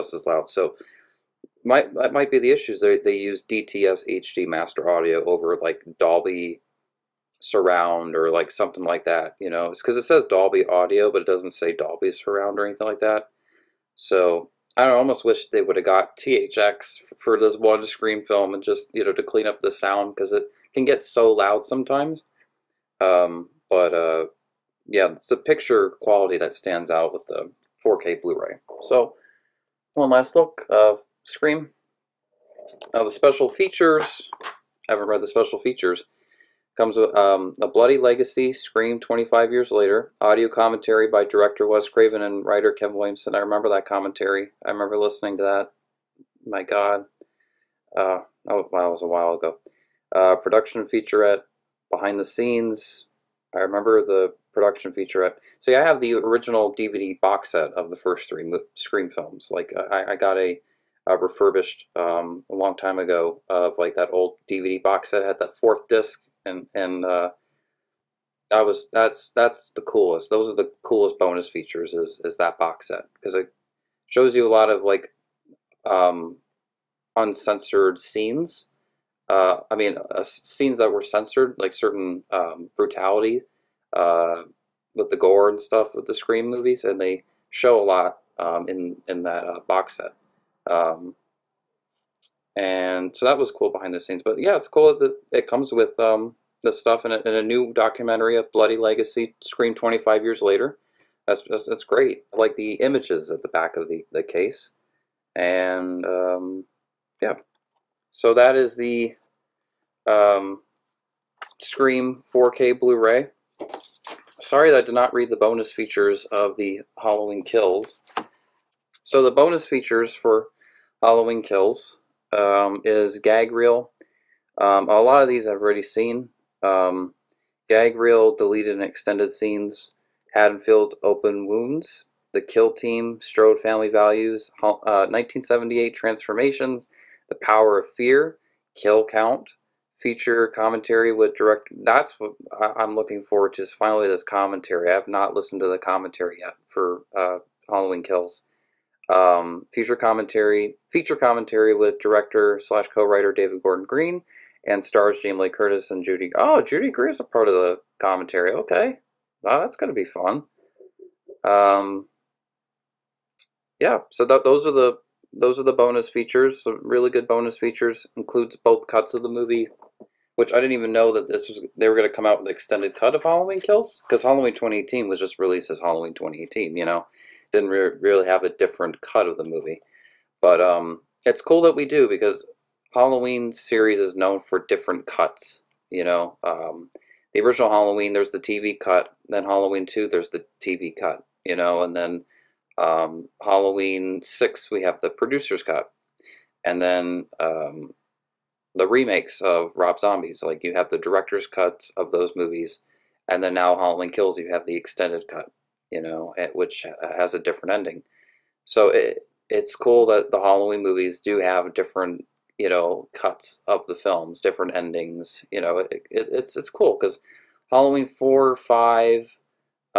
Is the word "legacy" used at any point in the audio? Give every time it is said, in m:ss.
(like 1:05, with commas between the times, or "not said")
0:37, 1:38.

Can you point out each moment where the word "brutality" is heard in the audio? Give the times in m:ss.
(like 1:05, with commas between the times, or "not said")
1:22.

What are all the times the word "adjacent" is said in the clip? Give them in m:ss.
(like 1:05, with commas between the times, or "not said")
not said.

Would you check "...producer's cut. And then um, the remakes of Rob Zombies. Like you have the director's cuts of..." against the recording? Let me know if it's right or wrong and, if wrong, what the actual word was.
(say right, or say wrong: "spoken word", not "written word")
right.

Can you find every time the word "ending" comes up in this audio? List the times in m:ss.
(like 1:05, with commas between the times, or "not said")
3:27, 3:34.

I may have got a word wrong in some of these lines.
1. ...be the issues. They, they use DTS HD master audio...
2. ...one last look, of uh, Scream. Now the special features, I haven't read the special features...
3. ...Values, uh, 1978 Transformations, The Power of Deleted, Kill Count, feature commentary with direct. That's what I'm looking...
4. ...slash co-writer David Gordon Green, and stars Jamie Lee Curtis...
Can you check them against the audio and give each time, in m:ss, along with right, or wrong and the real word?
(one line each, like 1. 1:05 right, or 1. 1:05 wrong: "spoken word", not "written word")
1. 0:02 right
2. 0:29 right
3. 2:13 wrong: "Fear", not "Deleted"
4. 2:32 right.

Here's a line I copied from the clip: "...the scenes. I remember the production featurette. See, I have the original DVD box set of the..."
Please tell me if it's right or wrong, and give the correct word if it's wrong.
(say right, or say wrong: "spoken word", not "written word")
right.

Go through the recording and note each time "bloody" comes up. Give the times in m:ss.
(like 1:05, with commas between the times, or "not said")
0:37, 1:38.